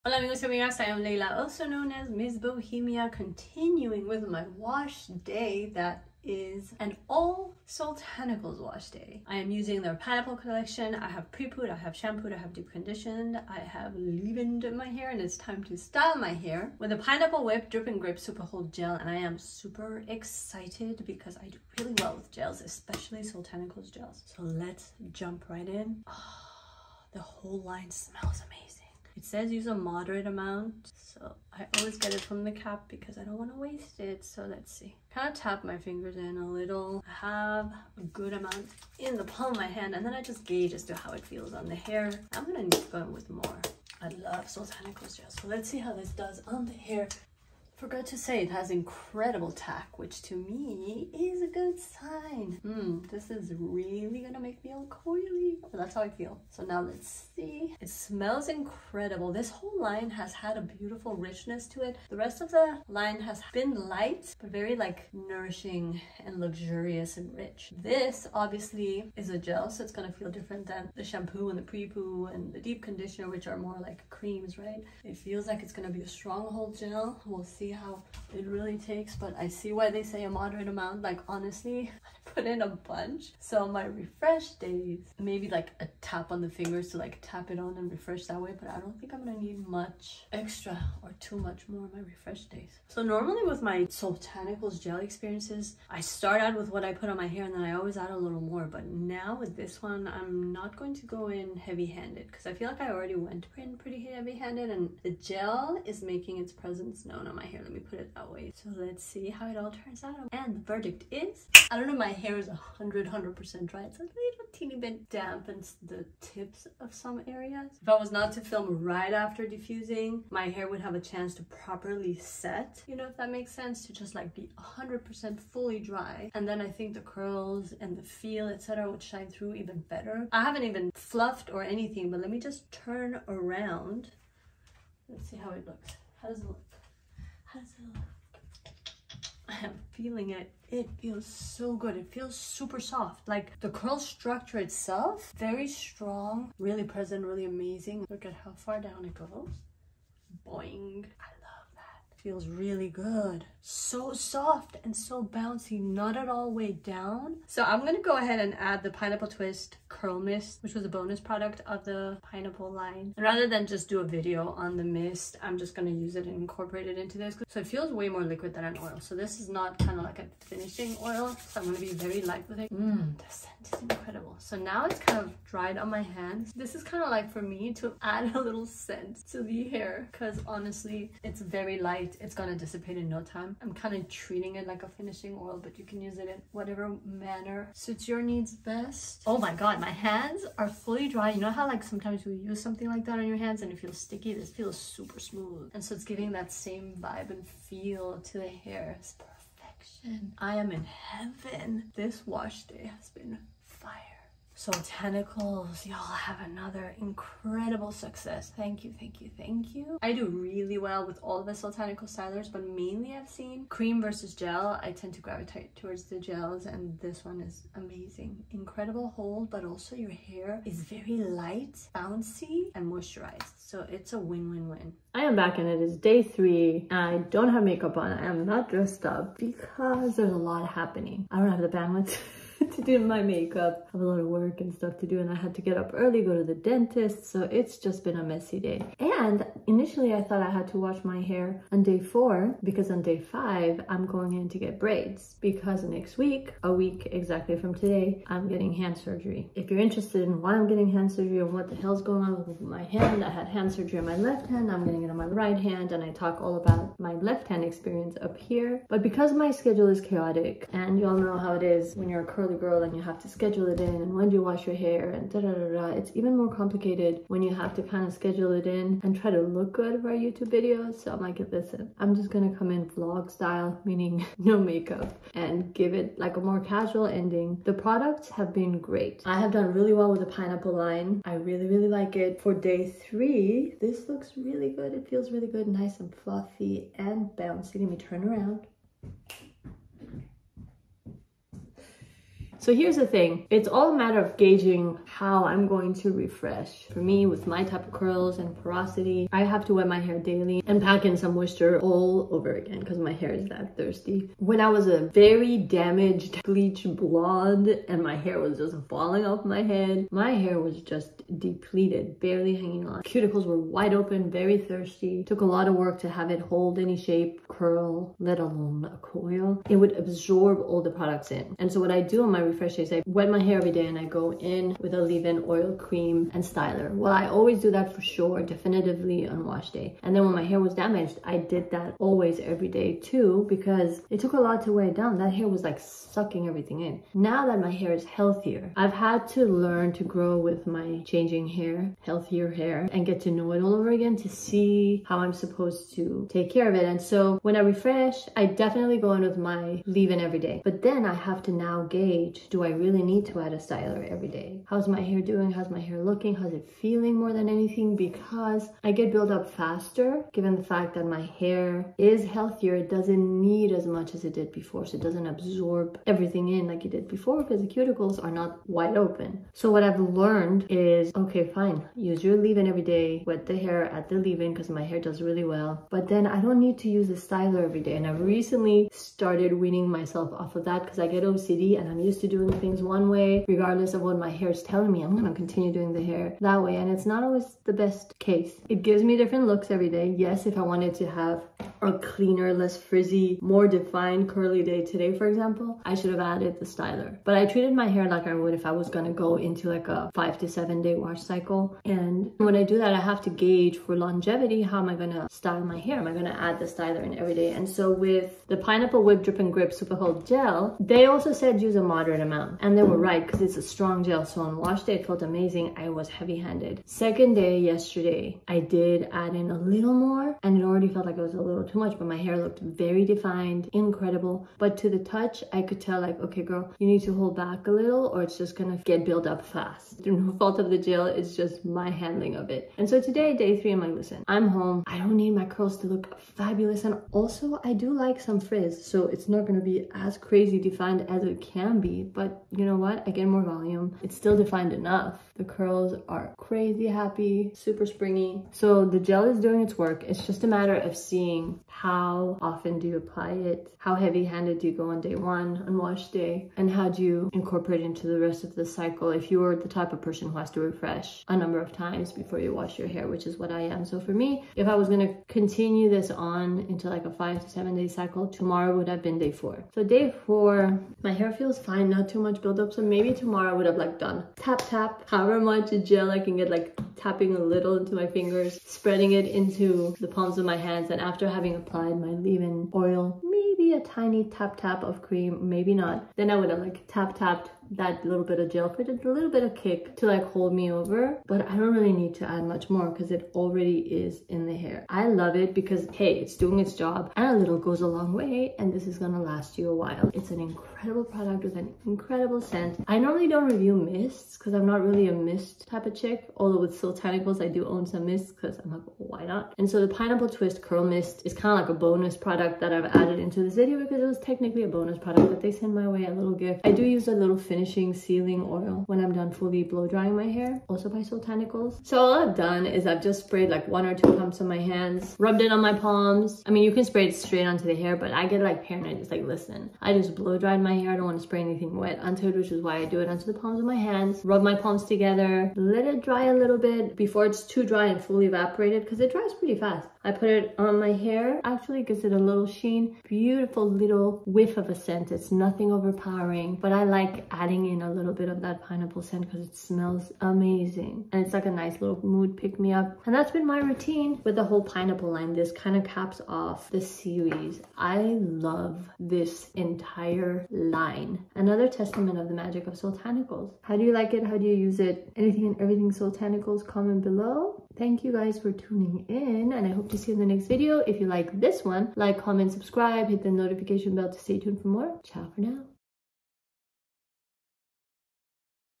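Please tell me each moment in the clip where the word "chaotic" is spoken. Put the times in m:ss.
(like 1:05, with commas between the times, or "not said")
4:20.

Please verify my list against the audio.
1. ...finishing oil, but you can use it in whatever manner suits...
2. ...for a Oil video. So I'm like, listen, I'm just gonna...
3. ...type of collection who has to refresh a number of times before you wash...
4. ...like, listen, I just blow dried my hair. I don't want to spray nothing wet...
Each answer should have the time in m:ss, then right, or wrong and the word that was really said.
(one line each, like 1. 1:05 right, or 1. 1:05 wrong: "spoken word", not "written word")
1. 3:04 right
2. 4:30 wrong: "YouTube", not "Oil"
3. 7:39 wrong: "person", not "collection"
4. 8:49 wrong: "anything", not "nothing".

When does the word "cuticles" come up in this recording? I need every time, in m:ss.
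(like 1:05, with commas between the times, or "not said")
5:13, 6:07.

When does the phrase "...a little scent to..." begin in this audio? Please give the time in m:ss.
2:58.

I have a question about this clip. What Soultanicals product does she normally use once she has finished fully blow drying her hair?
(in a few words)
Finishing Sealing Oil.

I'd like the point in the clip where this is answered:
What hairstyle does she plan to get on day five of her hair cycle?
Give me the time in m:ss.
4:04.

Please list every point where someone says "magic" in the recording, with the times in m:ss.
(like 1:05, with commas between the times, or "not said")
9:22.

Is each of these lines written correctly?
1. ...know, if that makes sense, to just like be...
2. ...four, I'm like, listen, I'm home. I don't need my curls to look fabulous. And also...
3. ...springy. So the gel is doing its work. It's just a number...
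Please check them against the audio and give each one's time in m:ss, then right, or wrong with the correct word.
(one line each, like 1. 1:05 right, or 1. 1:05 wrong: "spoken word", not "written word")
1. 2:02 right
2. 7:13 wrong: "three", not "four"
3. 7:27 wrong: "matter", not "number".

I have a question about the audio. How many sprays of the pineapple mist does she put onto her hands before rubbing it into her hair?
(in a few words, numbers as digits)
1 or 2 pumps.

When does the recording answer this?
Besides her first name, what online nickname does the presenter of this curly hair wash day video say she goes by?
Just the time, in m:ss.
0:02.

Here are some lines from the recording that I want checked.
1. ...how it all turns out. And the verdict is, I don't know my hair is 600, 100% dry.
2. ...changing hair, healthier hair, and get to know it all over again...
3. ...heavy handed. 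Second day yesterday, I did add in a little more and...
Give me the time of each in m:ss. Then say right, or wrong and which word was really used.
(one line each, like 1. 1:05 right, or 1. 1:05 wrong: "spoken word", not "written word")
1. 1:49 wrong: "100", not "600"
2. 5:41 right
3. 6:56 right.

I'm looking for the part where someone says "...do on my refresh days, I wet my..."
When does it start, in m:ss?
5:22.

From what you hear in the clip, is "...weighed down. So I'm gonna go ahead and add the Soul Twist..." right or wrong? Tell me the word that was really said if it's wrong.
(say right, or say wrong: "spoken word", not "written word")
wrong: "Pineapple", not "Soul".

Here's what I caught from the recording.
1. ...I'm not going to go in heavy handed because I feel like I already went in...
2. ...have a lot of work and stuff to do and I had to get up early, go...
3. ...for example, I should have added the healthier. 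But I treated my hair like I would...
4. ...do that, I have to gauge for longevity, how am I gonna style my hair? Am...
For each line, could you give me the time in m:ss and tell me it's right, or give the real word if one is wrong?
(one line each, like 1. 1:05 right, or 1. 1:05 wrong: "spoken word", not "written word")
1. 1:40 right
2. 3:53 right
3. 6:35 wrong: "styler", not "healthier"
4. 6:42 right.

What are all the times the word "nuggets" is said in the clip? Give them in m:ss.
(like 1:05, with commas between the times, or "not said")
not said.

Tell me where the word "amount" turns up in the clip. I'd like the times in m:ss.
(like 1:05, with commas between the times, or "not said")
0:30, 0:38, 1:20, 6:52.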